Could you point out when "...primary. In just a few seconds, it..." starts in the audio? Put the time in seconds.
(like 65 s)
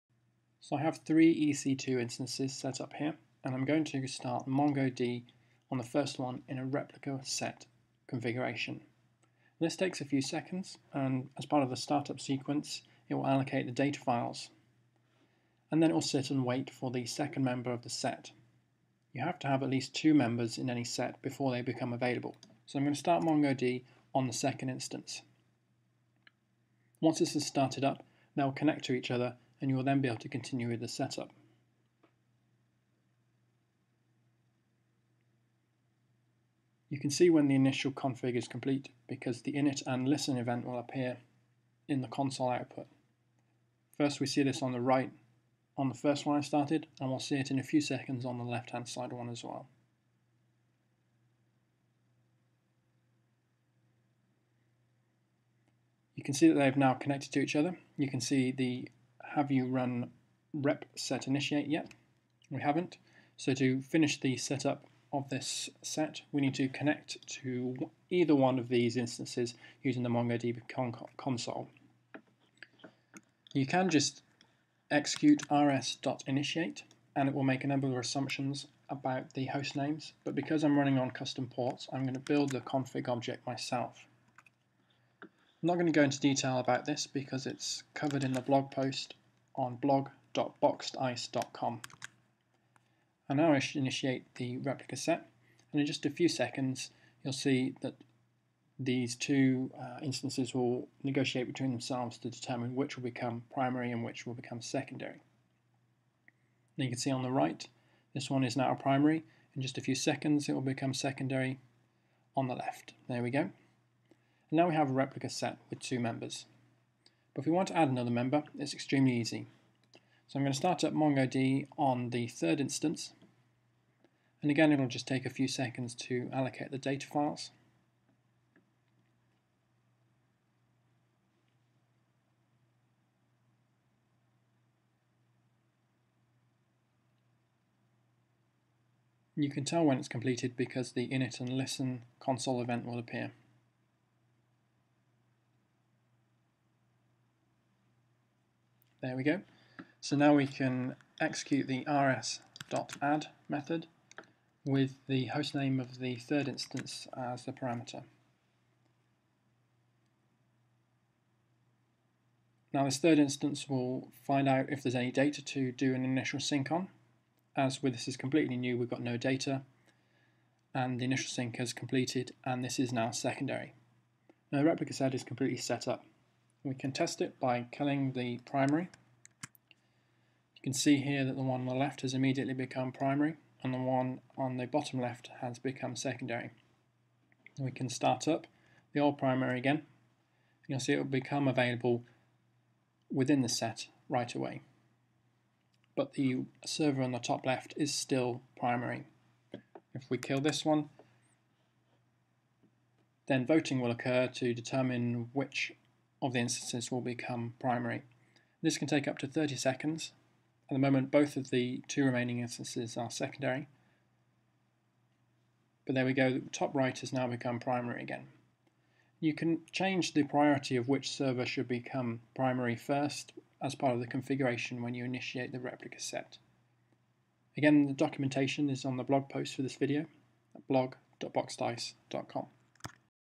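108 s.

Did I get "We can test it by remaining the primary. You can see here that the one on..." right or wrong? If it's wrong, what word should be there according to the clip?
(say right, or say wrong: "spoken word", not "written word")
wrong: "killing", not "remaining".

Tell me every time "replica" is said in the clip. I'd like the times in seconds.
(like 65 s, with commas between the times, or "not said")
6 s, 94 s, 114 s, 174 s, 225 s.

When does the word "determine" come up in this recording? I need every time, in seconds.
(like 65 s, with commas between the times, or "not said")
102 s, 204 s.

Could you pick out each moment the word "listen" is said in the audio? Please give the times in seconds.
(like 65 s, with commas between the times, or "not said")
40 s, 141 s.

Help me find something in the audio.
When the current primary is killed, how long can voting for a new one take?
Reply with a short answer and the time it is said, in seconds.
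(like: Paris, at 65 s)
30 seconds, at 209 s.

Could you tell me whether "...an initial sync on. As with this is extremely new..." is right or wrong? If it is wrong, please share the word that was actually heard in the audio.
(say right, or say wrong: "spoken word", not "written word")
wrong: "completely", not "extremely".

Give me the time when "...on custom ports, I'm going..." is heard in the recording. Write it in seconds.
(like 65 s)
80 s.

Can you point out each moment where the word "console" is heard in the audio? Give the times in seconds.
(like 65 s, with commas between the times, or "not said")
42 s, 71 s, 142 s.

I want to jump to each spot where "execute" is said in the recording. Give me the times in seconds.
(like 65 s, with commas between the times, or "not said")
74 s, 151 s.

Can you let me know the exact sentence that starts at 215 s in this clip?
But there we go, the top right has now become primary again.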